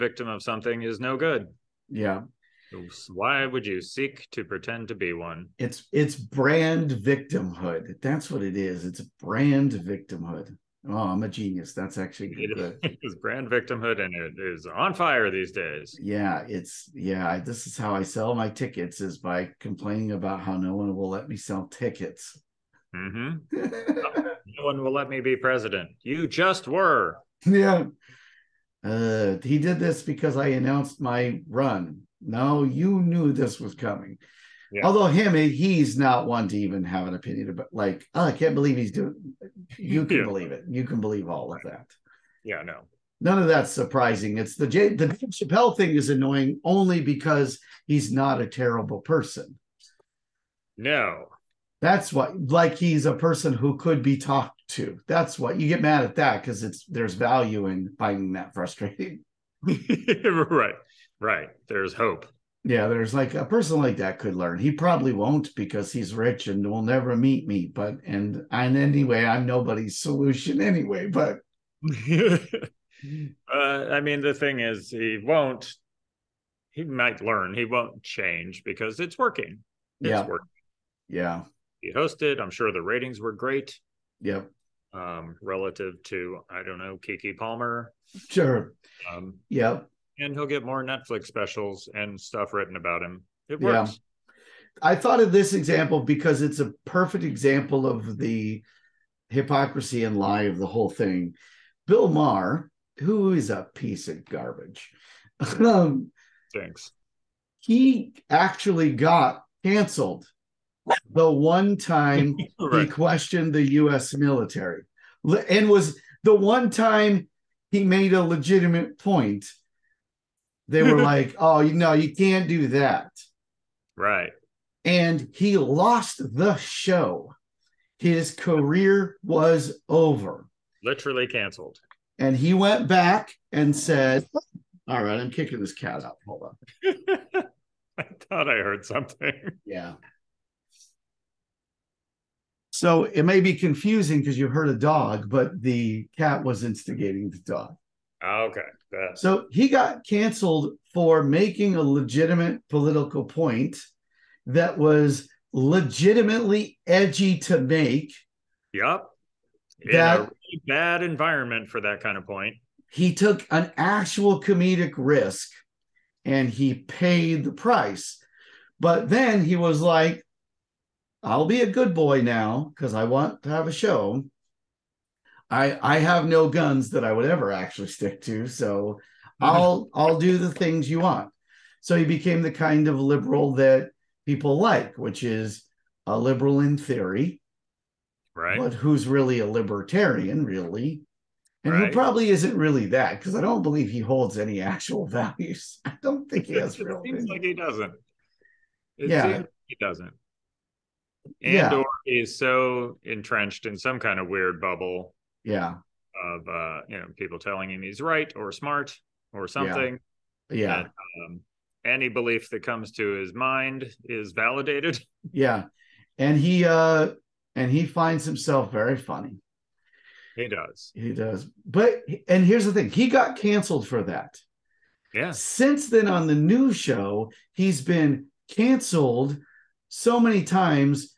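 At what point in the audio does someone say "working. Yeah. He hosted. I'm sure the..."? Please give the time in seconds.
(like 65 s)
80 s.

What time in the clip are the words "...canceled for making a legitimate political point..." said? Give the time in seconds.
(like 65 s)
150 s.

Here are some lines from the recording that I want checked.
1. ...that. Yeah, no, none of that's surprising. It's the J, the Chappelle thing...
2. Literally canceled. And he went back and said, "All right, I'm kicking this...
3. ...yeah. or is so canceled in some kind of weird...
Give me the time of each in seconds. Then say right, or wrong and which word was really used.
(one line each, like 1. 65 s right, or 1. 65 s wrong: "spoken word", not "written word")
1. 41 s right
2. 130 s right
3. 201 s wrong: "entrenched", not "canceled".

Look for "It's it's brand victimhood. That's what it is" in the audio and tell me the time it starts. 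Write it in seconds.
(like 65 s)
5 s.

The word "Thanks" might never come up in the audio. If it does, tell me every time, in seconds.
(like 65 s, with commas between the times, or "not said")
106 s.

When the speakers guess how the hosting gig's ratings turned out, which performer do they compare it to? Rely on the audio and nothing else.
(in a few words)
Keke Palmer.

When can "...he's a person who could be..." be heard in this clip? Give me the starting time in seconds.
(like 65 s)
52 s.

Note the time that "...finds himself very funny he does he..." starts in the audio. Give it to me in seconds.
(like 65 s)
217 s.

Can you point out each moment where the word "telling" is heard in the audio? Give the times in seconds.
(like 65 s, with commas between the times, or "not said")
207 s.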